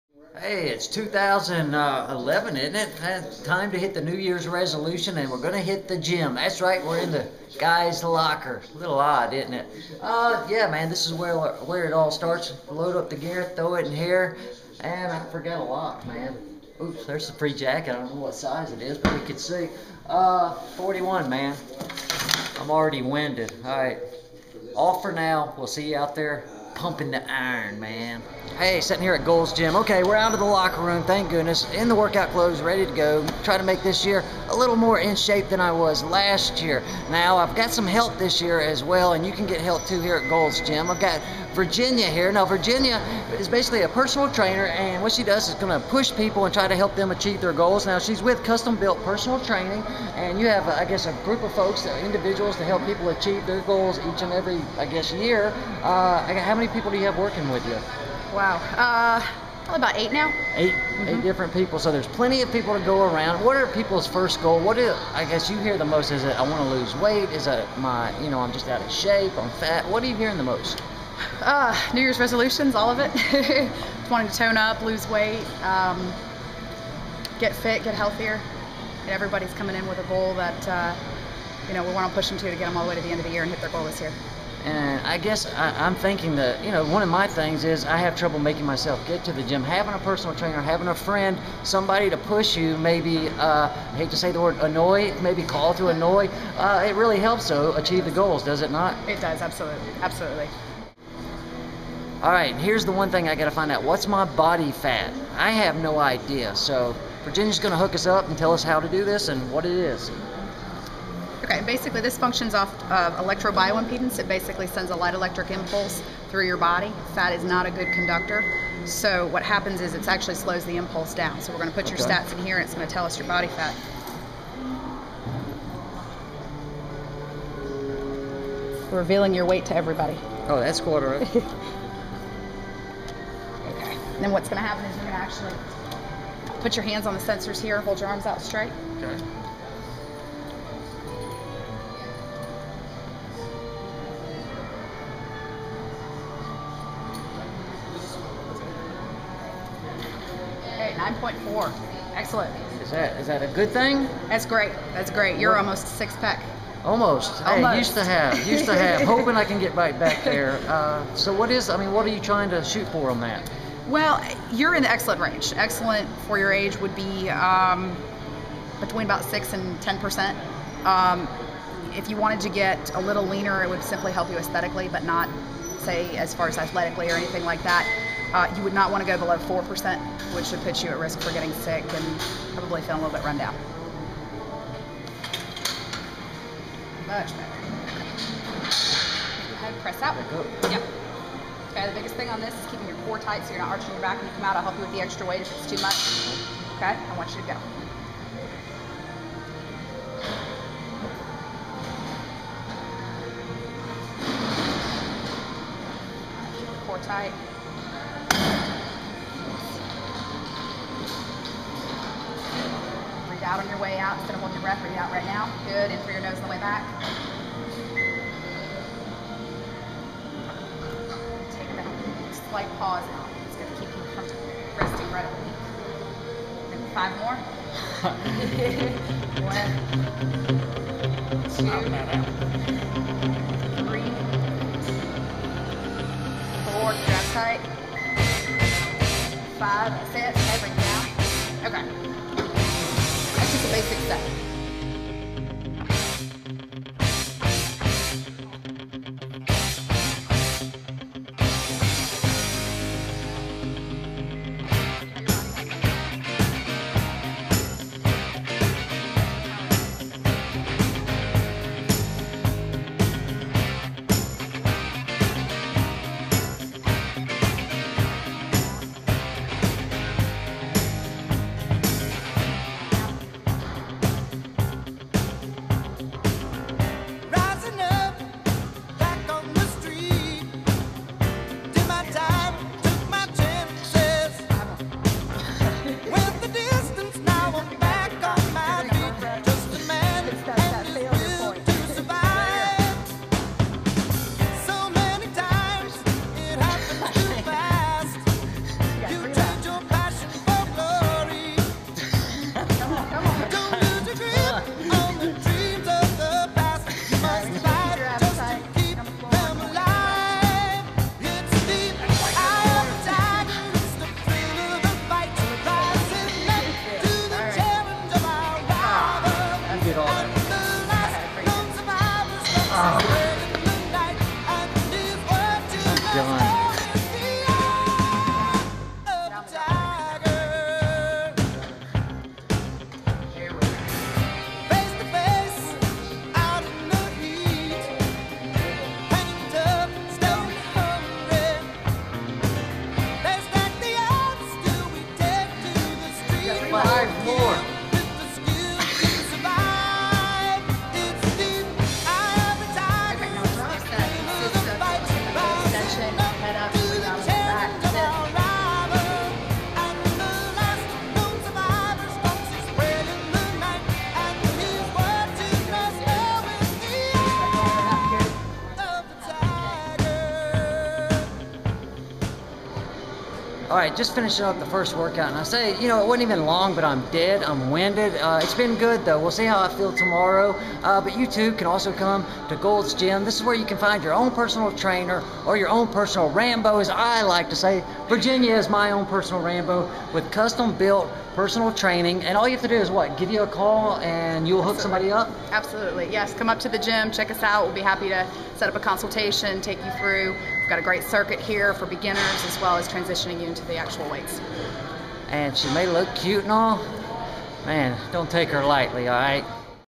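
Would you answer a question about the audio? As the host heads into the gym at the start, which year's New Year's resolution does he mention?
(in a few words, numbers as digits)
2011.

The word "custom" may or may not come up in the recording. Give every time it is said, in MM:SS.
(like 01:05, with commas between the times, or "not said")
00:48, 06:30.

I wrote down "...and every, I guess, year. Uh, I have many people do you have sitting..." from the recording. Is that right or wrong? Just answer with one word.
wrong.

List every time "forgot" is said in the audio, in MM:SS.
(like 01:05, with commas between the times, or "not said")
00:15.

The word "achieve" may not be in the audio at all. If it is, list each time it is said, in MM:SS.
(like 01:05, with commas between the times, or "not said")
00:47, 00:53, 01:37.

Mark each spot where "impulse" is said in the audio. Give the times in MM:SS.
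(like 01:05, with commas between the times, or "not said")
01:55, 02:00.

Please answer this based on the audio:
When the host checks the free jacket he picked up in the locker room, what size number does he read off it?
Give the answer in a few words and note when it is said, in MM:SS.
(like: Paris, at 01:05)
41, at 00:20.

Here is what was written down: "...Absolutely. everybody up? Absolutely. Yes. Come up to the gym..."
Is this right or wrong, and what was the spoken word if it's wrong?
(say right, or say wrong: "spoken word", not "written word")
wrong: "somebody", not "everybody".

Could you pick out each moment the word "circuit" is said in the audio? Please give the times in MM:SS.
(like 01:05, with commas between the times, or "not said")
06:41.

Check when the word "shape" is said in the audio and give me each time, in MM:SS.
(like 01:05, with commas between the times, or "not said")
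00:35, 01:09.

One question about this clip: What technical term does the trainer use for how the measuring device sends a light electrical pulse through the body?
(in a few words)
electrobioimpedance.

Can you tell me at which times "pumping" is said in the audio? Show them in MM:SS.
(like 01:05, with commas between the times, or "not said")
00:26.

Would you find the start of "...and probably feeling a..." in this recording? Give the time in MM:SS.
03:01.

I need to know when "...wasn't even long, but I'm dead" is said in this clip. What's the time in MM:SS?
06:16.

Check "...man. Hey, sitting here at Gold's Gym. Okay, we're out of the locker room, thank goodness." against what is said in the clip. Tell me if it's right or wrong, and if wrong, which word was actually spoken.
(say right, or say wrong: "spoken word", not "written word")
right.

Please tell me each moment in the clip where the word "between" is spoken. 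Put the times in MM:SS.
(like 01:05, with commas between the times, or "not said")
02:48.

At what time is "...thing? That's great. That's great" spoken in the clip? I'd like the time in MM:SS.
02:33.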